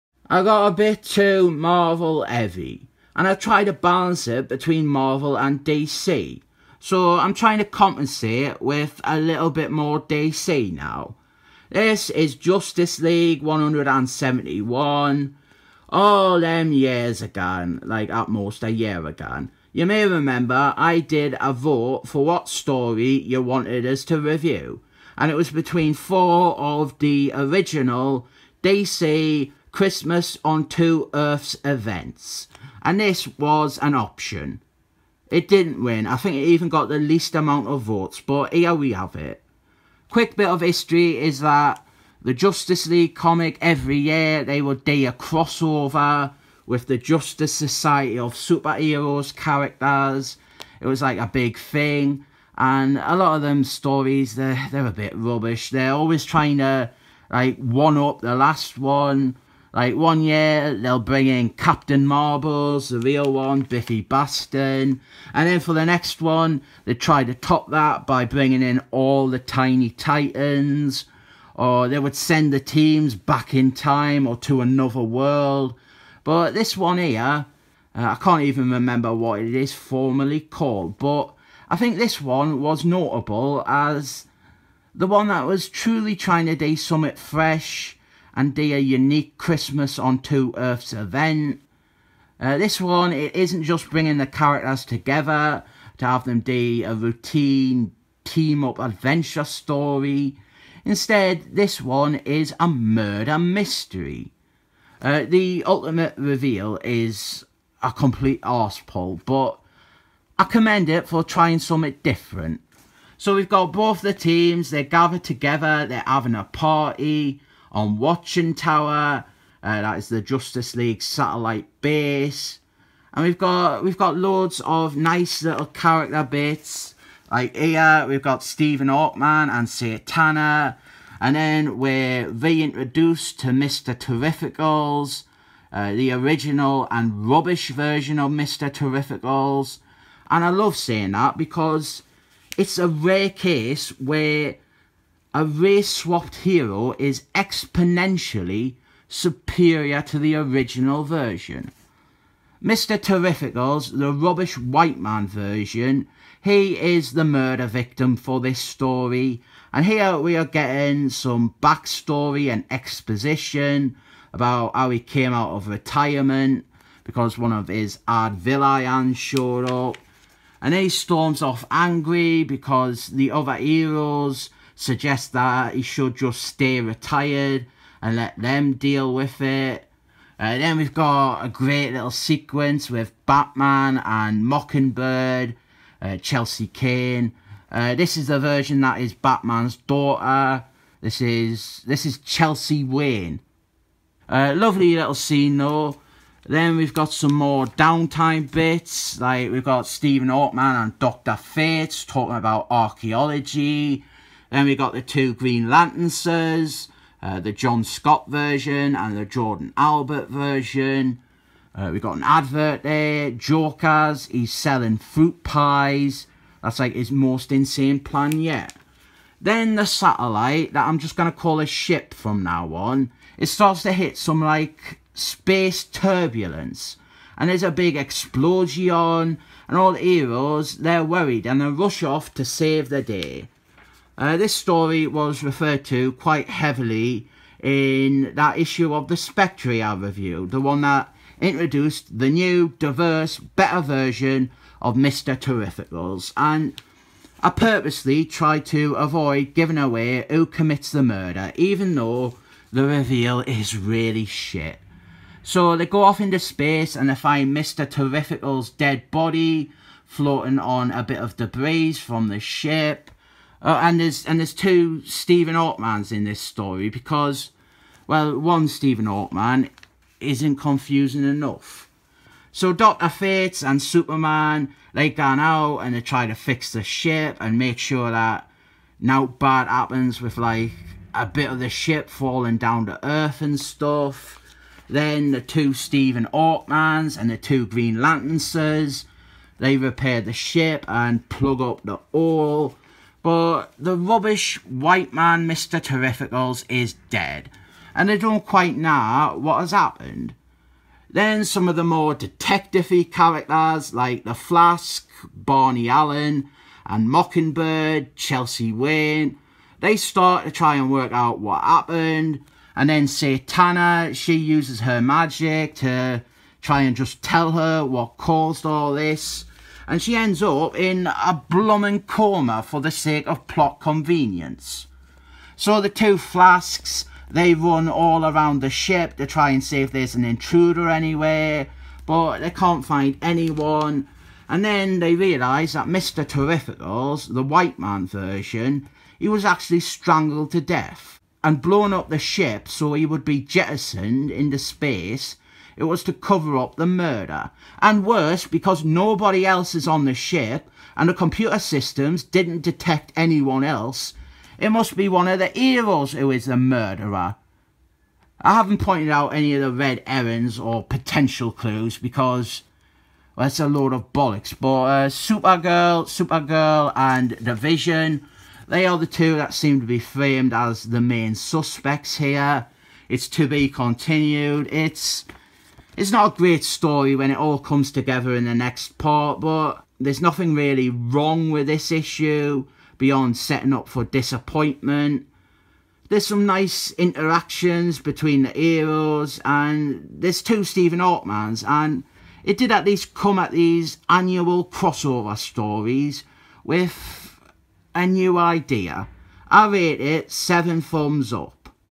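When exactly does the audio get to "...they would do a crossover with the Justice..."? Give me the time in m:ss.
0:44.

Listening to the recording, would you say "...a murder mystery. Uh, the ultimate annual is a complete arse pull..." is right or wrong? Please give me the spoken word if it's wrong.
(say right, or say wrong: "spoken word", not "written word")
wrong: "reveal", not "annual".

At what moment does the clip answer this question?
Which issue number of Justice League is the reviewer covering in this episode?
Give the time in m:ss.
0:13.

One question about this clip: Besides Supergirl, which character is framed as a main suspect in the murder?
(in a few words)
The Vision.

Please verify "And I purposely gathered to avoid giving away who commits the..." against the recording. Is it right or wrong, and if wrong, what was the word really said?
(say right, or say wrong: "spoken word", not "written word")
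wrong: "tried", not "gathered".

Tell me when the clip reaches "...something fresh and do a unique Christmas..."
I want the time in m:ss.
1:26.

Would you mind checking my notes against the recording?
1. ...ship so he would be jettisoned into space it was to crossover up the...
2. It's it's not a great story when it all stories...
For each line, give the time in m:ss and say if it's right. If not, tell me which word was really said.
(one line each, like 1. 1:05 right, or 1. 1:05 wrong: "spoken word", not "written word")
1. 5:42 wrong: "cover", not "crossover"
2. 6:14 wrong: "comes", not "stories".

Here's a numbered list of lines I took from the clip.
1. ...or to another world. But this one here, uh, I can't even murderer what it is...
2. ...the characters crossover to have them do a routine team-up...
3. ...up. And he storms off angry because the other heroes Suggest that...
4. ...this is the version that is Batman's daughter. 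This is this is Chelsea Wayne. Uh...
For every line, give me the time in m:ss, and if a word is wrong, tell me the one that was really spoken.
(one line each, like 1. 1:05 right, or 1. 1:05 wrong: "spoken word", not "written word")
1. 1:14 wrong: "remember", not "murderer"
2. 1:34 wrong: "together", not "crossover"
3. 2:49 right
4. 3:07 right.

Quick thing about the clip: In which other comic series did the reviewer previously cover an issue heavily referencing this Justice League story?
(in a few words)
The Spectre.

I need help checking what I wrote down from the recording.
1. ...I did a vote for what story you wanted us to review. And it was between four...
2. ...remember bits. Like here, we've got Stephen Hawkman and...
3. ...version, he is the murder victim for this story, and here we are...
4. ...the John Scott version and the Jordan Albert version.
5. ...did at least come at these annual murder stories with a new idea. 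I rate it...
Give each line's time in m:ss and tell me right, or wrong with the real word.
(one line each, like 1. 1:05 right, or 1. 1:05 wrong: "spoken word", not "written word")
1. 0:20 right
2. 2:05 wrong: "character", not "remember"
3. 2:35 right
4. 3:27 right
5. 6:32 wrong: "crossover", not "murder".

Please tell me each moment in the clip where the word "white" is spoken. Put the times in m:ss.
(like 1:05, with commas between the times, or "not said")
2:34, 4:54, 5:37.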